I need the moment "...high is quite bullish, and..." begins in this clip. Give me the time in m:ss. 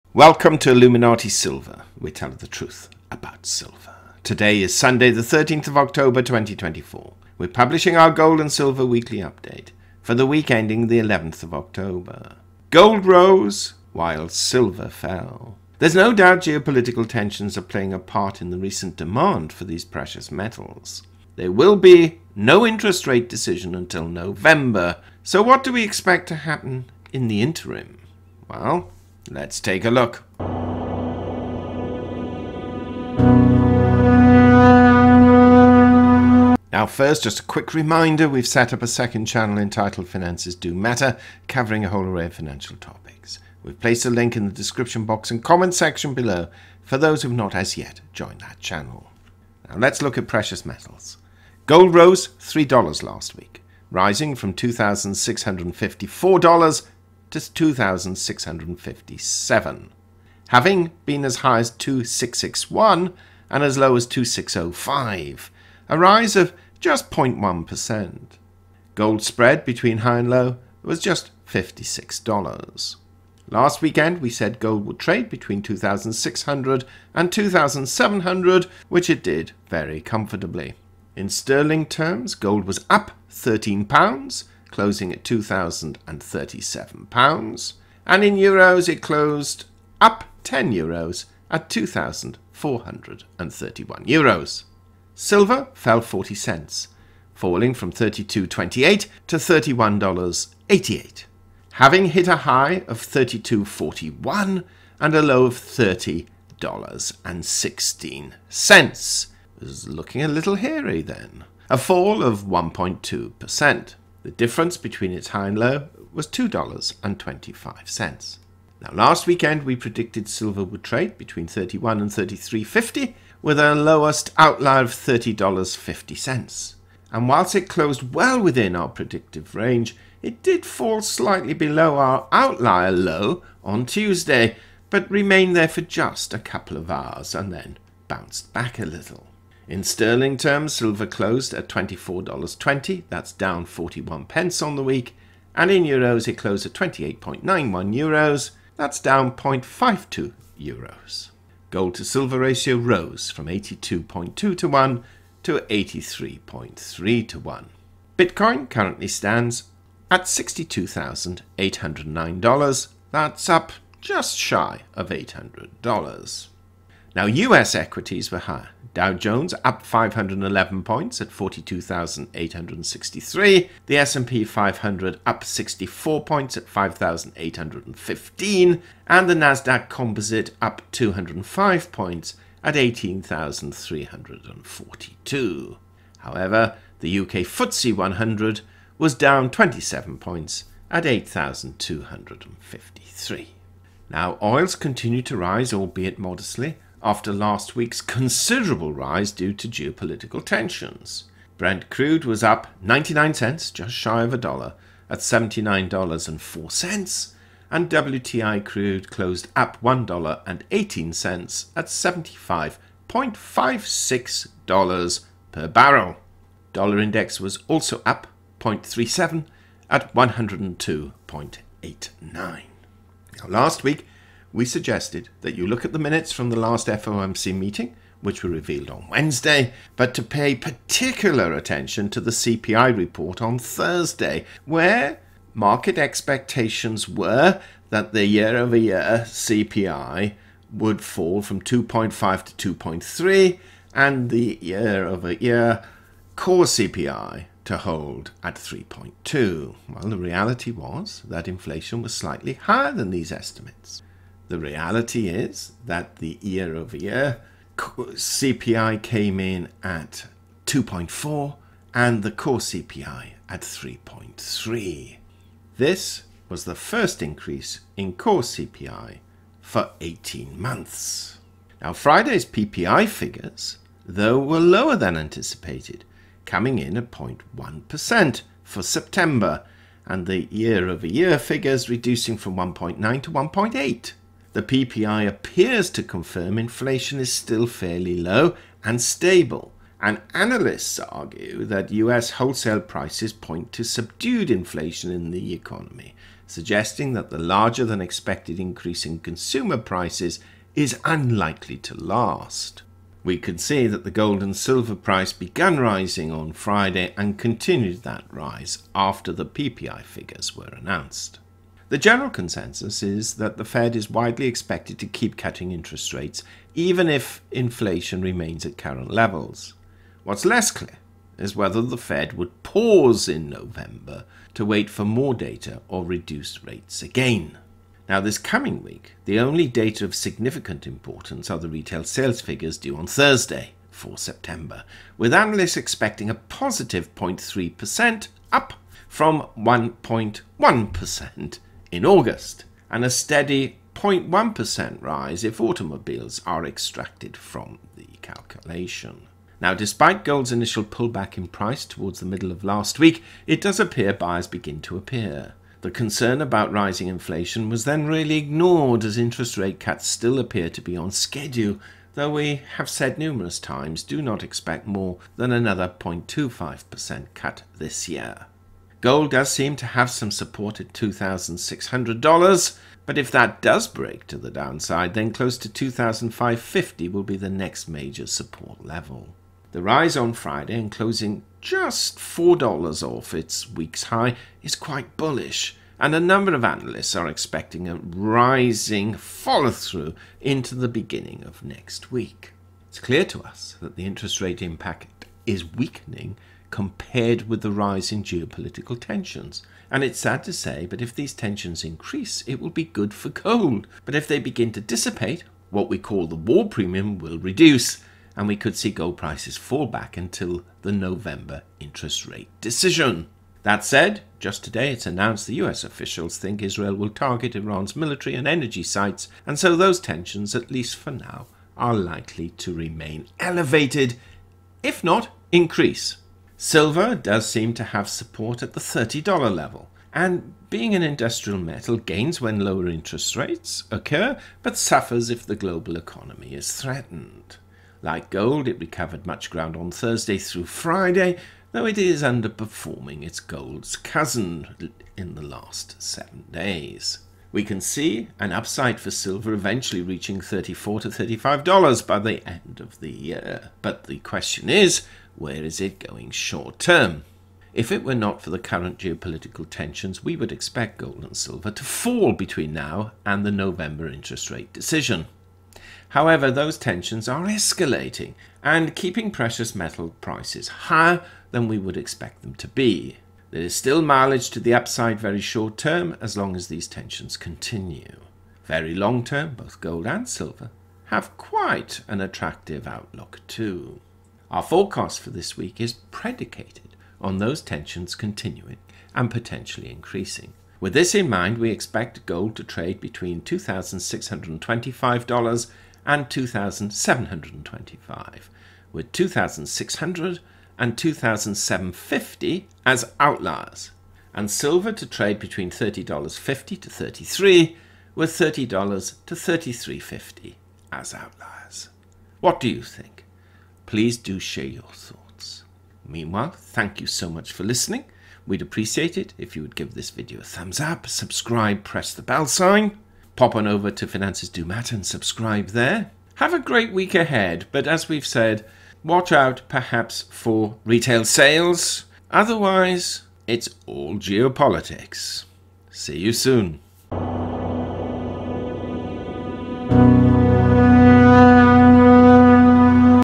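6:24.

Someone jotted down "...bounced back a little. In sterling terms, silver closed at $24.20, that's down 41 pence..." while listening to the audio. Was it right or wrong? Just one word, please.
right.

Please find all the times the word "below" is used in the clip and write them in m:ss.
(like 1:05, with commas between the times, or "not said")
0:46, 2:11.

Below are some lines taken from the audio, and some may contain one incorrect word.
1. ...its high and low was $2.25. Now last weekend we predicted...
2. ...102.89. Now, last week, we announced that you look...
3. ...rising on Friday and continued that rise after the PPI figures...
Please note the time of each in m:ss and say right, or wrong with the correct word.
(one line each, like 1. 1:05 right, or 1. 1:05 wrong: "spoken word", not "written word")
1. 1:55 right
2. 3:40 wrong: "suggested", not "announced"
3. 5:05 right.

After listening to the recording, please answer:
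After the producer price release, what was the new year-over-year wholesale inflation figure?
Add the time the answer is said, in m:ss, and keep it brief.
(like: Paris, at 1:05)
1.8, at 4:42.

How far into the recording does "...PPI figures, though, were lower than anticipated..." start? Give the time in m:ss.
4:32.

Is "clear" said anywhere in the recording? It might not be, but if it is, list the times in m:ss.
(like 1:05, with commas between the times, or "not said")
5:20, 6:32.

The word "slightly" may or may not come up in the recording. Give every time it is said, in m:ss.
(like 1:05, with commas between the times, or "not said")
2:11, 4:12.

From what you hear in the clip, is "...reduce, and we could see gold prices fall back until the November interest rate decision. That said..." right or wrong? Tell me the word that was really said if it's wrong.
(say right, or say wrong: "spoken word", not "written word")
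right.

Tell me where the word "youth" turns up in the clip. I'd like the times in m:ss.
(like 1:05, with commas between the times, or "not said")
not said.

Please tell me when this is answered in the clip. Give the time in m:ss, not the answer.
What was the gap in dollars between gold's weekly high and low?
1:11.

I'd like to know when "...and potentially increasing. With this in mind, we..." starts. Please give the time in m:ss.
8:09.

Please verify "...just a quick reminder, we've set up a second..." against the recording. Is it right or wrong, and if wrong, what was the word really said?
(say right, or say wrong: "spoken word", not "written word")
right.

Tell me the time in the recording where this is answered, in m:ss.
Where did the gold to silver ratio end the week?
2:35.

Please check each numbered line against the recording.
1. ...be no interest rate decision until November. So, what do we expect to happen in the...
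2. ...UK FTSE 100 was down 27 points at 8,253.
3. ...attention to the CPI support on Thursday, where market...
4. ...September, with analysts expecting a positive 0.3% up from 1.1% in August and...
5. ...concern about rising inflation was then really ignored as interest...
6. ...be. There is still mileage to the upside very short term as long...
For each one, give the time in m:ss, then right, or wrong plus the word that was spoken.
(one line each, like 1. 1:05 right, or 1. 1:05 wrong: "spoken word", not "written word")
1. 0:21 right
2. 3:07 right
3. 3:51 wrong: "report", not "support"
4. 5:34 right
5. 5:55 right
6. 7:52 right.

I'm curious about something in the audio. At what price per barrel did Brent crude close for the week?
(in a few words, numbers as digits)
$79.04.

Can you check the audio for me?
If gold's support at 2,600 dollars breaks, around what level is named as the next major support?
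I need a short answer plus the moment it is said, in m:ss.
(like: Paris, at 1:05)
2,550, at 6:15.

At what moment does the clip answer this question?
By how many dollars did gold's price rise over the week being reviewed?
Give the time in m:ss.
0:51.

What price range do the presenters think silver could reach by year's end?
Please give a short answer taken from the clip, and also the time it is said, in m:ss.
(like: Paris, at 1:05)
$34 to $35, at 7:30.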